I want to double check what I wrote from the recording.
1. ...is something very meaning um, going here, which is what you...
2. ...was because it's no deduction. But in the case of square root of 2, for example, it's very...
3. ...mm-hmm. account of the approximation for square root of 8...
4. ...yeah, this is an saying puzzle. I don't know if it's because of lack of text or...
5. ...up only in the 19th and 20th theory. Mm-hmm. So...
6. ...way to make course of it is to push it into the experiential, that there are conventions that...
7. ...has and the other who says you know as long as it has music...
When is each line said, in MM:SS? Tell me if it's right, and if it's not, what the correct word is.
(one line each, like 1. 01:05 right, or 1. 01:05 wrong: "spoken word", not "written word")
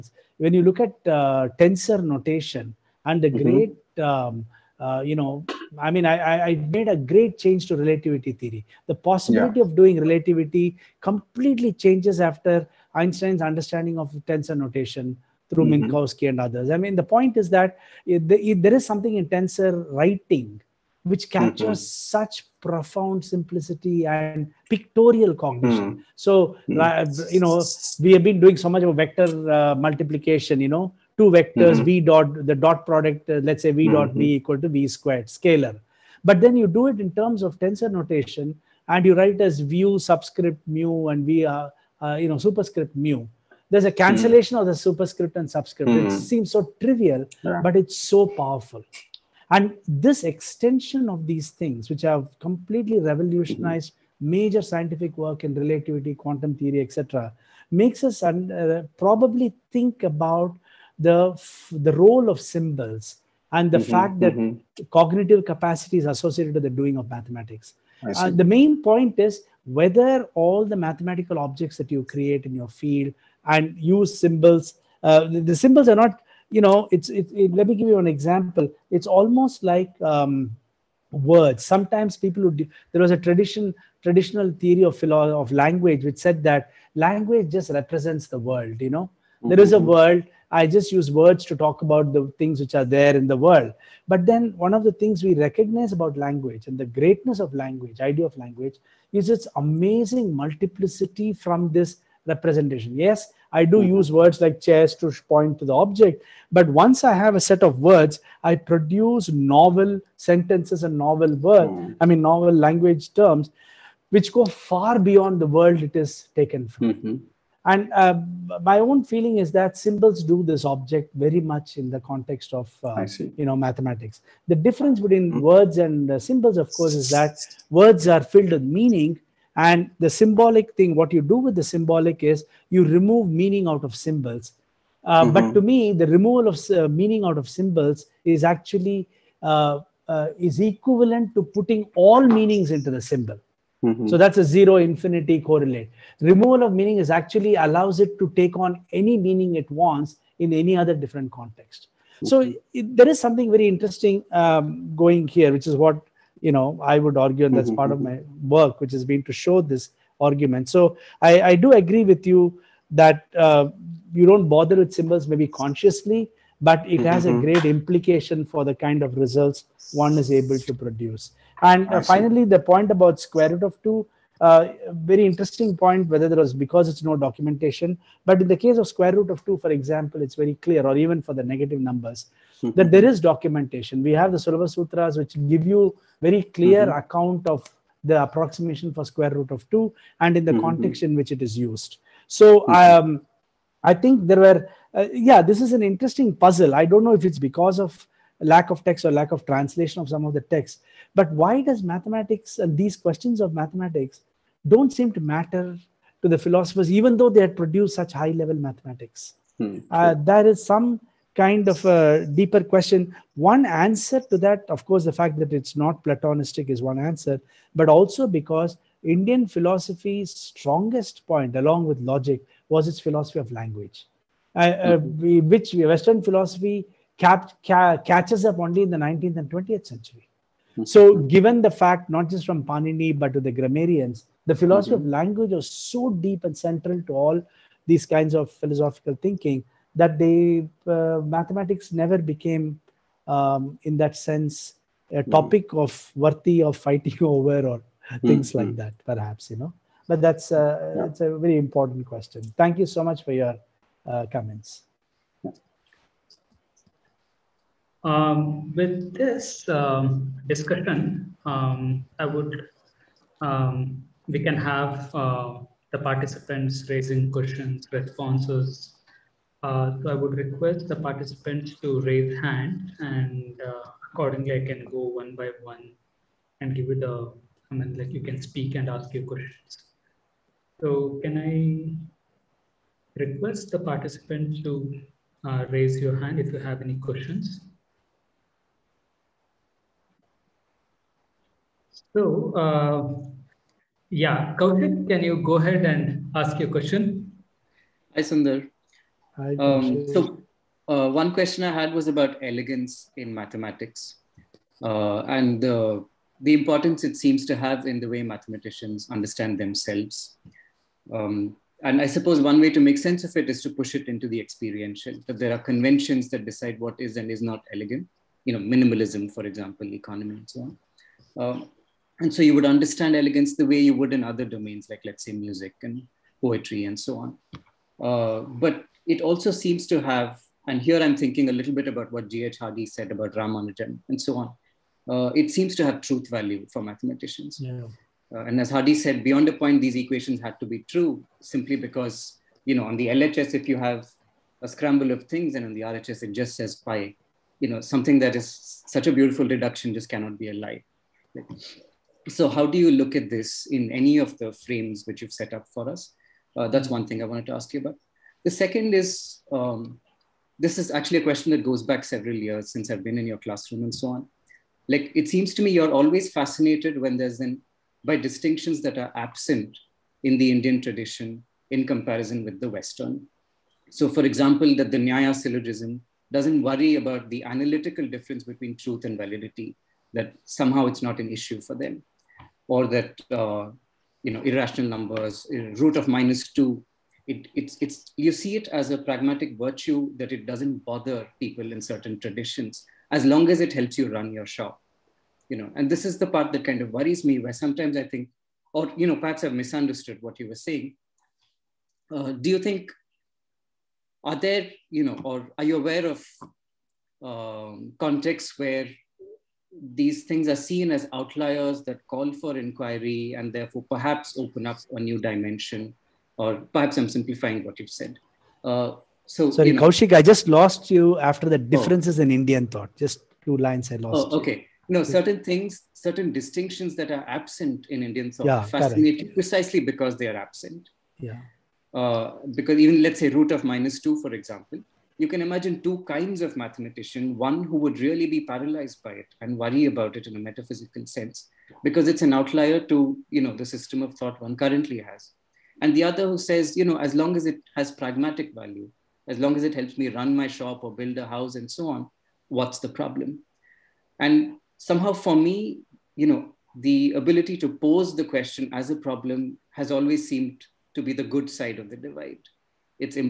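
1. 02:33 wrong: "interesting", not "meaning"
2. 02:56 wrong: "documentation", not "deduction"
3. 03:06 wrong: "2", not "8"
4. 03:15 wrong: "interesting", not "saying"
5. 03:48 wrong: "century", not "theory"
6. 05:12 wrong: "sense", not "course"
7. 07:24 wrong: "pragmatic", not "music".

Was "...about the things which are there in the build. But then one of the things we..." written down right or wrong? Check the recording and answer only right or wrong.
wrong.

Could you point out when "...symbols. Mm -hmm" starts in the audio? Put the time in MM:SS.
02:14.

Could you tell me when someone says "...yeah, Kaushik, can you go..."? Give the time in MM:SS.
04:54.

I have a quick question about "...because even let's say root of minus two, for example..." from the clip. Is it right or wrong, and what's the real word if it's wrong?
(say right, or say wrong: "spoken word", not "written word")
right.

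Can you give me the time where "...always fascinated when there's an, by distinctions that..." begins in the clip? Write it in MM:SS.
06:05.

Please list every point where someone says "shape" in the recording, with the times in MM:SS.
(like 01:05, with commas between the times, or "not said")
not said.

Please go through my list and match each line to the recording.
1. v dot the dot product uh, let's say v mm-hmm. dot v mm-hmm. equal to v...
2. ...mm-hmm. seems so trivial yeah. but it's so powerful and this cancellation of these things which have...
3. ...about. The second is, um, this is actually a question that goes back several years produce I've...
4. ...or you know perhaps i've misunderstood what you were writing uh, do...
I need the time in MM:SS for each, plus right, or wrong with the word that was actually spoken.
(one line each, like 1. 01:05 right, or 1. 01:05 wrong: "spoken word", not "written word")
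1. 00:31 right
2. 00:45 wrong: "extension", not "cancellation"
3. 05:57 wrong: "since", not "produce"
4. 06:38 wrong: "saying", not "writing".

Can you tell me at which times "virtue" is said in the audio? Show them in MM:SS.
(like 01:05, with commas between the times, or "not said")
06:29.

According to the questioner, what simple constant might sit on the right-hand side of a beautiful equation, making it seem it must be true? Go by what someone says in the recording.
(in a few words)
pi.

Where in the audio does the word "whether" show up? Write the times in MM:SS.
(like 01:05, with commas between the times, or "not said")
01:09, 02:56.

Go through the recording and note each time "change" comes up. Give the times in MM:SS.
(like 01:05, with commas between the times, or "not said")
00:07, 00:11.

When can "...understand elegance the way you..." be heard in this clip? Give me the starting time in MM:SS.
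05:22.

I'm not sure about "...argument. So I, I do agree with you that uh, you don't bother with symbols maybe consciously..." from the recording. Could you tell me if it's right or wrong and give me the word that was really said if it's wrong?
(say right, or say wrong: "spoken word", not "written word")
right.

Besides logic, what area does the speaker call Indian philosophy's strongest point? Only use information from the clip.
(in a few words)
philosophy of language.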